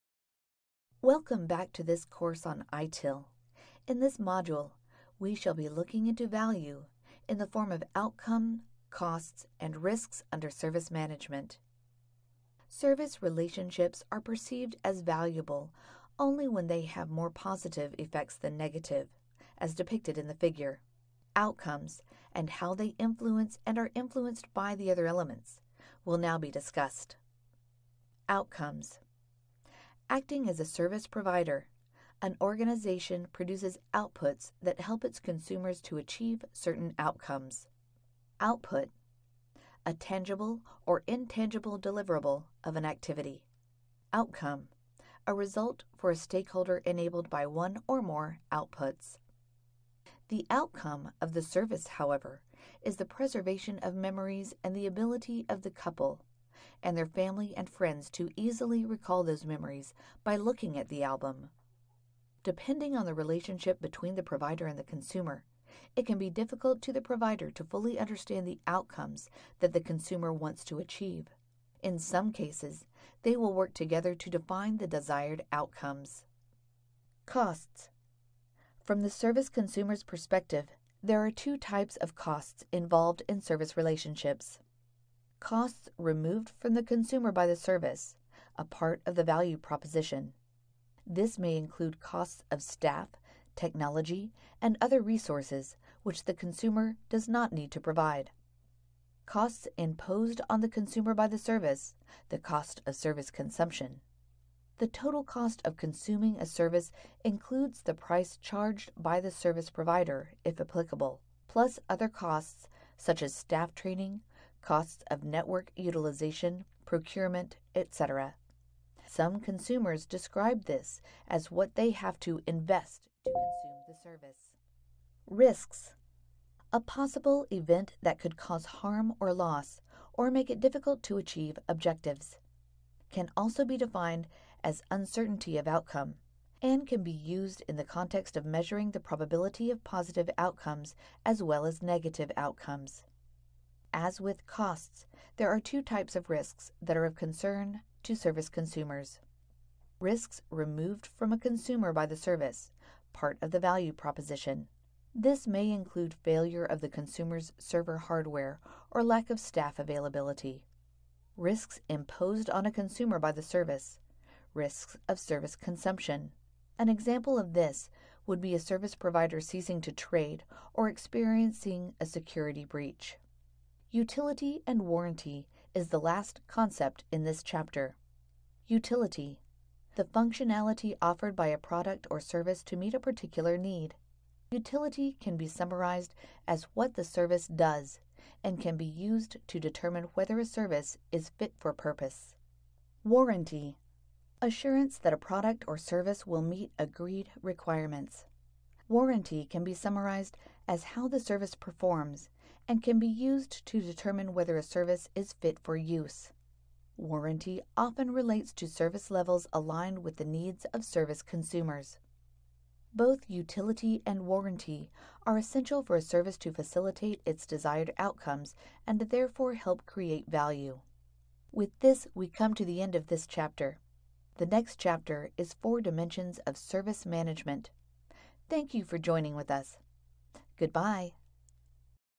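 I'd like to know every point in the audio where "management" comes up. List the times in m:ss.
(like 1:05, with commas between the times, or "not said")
0:10, 3:47.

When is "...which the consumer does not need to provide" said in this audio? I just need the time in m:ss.
1:36.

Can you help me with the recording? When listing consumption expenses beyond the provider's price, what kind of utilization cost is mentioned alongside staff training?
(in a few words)
Network utilization.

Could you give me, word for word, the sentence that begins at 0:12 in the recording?
Service relationships are perceived as valuable only when they have more positive effects than negative, as depicted in the figure.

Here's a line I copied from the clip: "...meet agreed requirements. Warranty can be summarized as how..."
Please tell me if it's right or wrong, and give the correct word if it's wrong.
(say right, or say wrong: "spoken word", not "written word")
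right.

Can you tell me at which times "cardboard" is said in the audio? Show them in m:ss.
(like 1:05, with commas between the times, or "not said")
not said.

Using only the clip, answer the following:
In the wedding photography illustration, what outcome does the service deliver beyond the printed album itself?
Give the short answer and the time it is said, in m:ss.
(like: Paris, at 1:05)
Preservation of memories, at 0:53.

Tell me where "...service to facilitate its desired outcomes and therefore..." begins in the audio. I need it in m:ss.
3:36.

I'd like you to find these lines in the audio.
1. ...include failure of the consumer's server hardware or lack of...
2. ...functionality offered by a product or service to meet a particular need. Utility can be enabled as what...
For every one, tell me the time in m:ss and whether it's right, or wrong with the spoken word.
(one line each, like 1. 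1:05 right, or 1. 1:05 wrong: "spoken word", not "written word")
1. 2:35 right
2. 3:00 wrong: "summarized", not "enabled".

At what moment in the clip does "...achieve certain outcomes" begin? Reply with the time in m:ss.
0:35.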